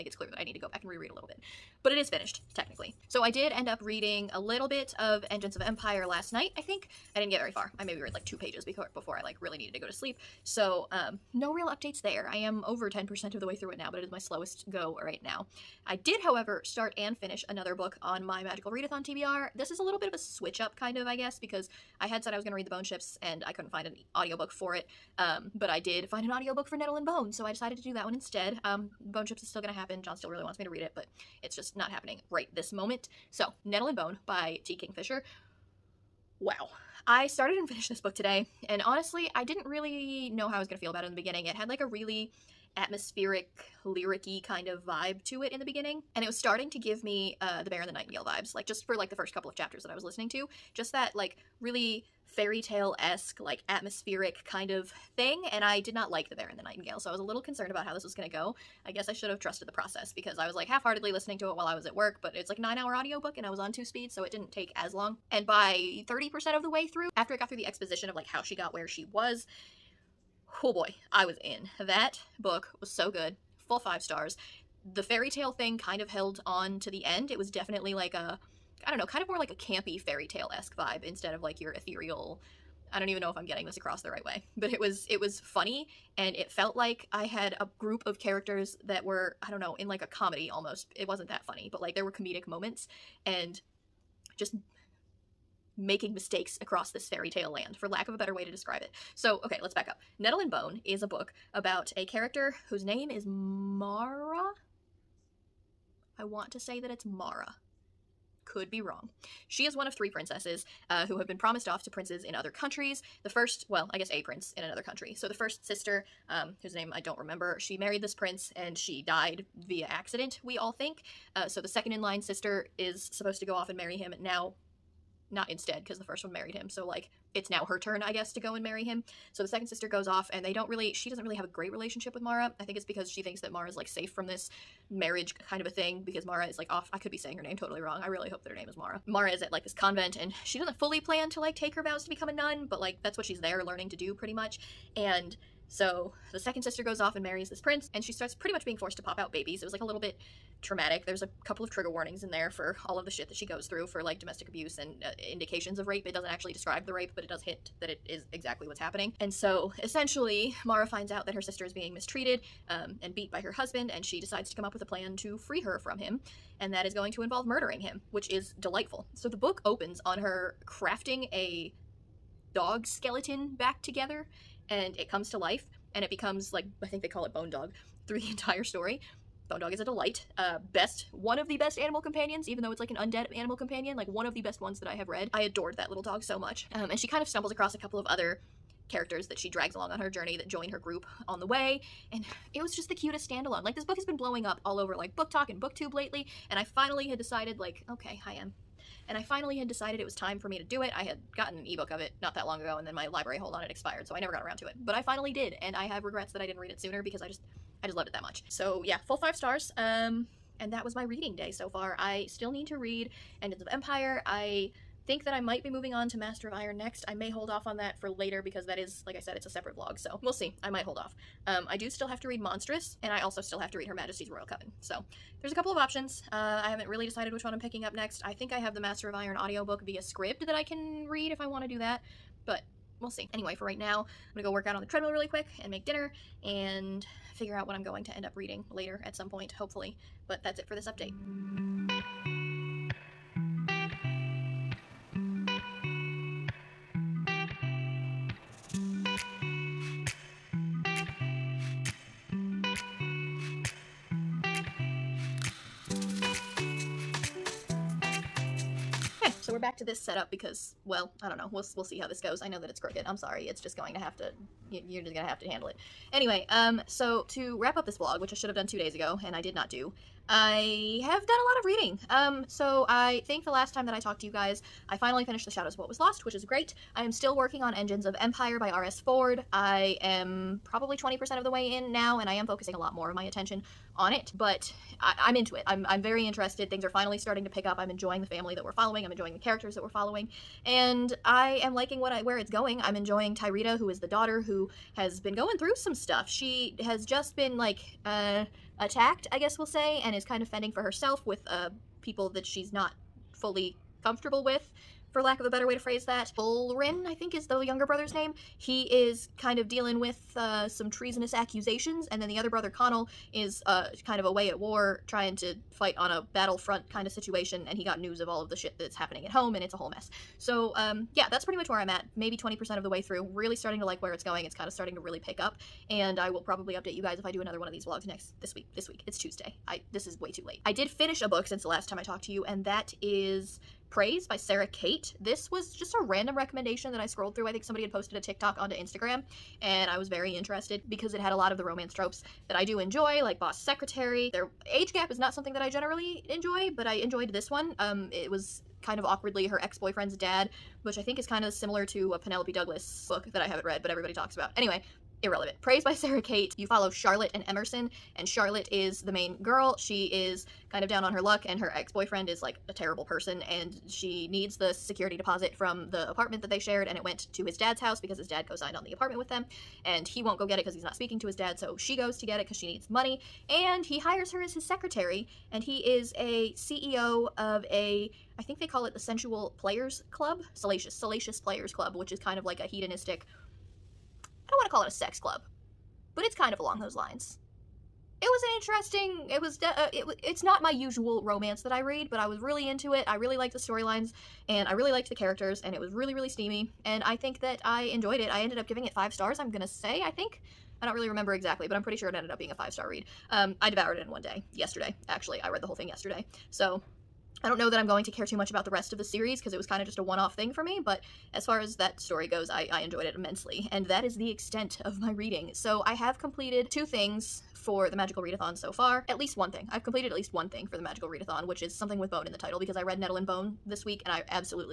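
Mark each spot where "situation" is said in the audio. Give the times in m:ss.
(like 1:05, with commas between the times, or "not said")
5:17.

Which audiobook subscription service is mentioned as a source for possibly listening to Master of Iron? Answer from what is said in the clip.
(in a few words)
Scribd.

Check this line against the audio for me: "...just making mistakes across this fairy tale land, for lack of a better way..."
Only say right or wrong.
right.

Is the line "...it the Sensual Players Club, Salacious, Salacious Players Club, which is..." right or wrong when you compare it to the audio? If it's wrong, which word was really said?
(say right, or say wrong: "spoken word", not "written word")
right.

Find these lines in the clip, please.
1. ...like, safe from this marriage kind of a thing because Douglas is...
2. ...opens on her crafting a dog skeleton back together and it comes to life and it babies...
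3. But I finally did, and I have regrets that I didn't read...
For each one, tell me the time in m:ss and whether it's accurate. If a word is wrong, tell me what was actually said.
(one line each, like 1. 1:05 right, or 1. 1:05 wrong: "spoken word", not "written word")
1. 2:13 wrong: "Marra", not "Douglas"
2. 2:49 wrong: "becomes", not "babies"
3. 3:24 right.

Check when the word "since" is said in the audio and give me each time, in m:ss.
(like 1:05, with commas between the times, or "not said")
5:31.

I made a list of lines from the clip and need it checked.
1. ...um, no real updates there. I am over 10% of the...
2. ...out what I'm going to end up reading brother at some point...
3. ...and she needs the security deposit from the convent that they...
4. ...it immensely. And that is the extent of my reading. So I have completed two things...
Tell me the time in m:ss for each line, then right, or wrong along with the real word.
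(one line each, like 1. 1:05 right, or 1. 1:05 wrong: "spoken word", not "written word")
1. 0:10 right
2. 3:57 wrong: "later", not "brother"
3. 6:03 wrong: "apartment", not "convent"
4. 6:53 right.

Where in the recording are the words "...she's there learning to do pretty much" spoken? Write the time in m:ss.
2:23.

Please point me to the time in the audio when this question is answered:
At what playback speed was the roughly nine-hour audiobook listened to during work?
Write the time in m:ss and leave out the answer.
1:03.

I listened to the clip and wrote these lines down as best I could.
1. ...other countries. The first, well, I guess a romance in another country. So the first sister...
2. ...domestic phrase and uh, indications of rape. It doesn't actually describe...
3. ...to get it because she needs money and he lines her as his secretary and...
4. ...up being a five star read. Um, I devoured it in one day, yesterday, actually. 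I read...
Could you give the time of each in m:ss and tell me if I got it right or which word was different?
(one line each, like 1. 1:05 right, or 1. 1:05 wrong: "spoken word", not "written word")
1. 1:52 wrong: "prince", not "romance"
2. 2:34 wrong: "abuse", not "phrase"
3. 6:12 wrong: "hires", not "lines"
4. 6:42 right.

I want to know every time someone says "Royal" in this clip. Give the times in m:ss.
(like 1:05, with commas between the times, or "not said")
3:44.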